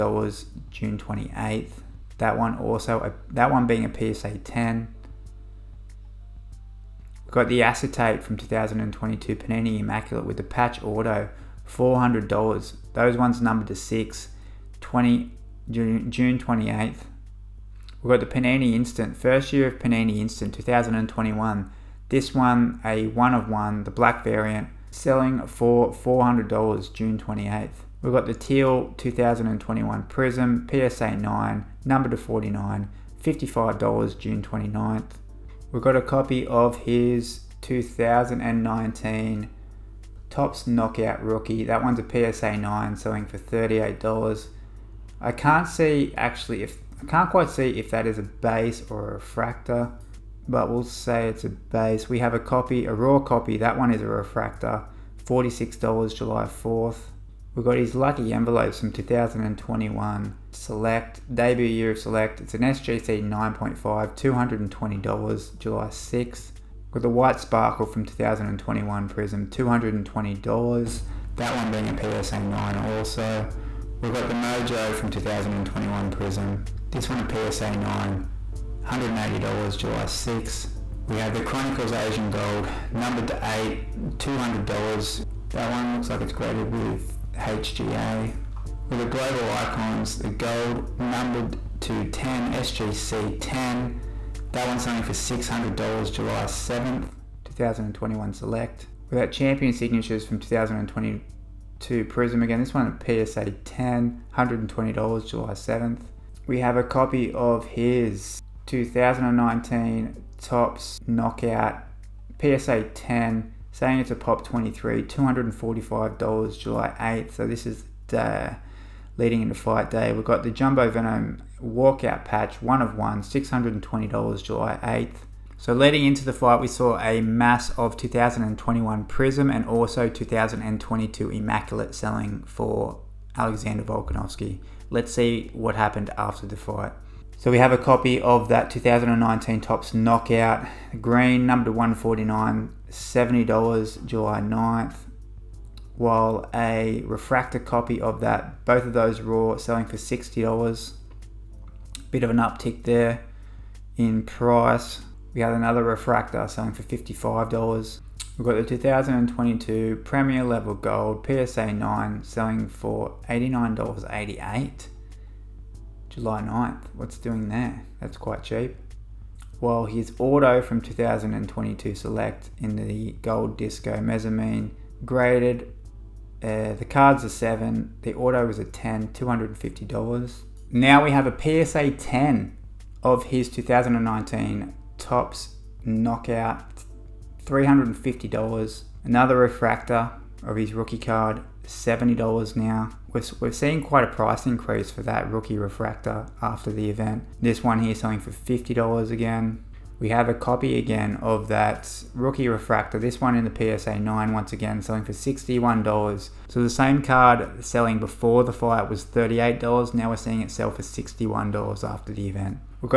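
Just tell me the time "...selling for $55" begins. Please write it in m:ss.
2:36.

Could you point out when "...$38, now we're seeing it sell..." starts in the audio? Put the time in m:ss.
3:29.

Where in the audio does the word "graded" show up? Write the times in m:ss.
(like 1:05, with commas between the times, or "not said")
1:26, 2:55.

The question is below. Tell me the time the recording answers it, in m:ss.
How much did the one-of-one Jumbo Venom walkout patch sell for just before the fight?
2:03.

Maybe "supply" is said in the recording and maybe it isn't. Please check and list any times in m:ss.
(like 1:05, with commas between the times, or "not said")
not said.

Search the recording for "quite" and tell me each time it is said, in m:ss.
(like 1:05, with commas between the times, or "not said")
0:47, 2:48, 3:13.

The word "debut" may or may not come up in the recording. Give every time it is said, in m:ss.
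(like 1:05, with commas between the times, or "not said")
1:01.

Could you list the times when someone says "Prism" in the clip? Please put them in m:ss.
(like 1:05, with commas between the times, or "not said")
0:30, 1:09, 1:16, 1:42, 2:09.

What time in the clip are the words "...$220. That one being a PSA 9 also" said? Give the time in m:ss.
1:09.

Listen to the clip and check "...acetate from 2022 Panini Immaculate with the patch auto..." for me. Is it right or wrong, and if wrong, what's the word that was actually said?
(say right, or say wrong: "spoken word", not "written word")
right.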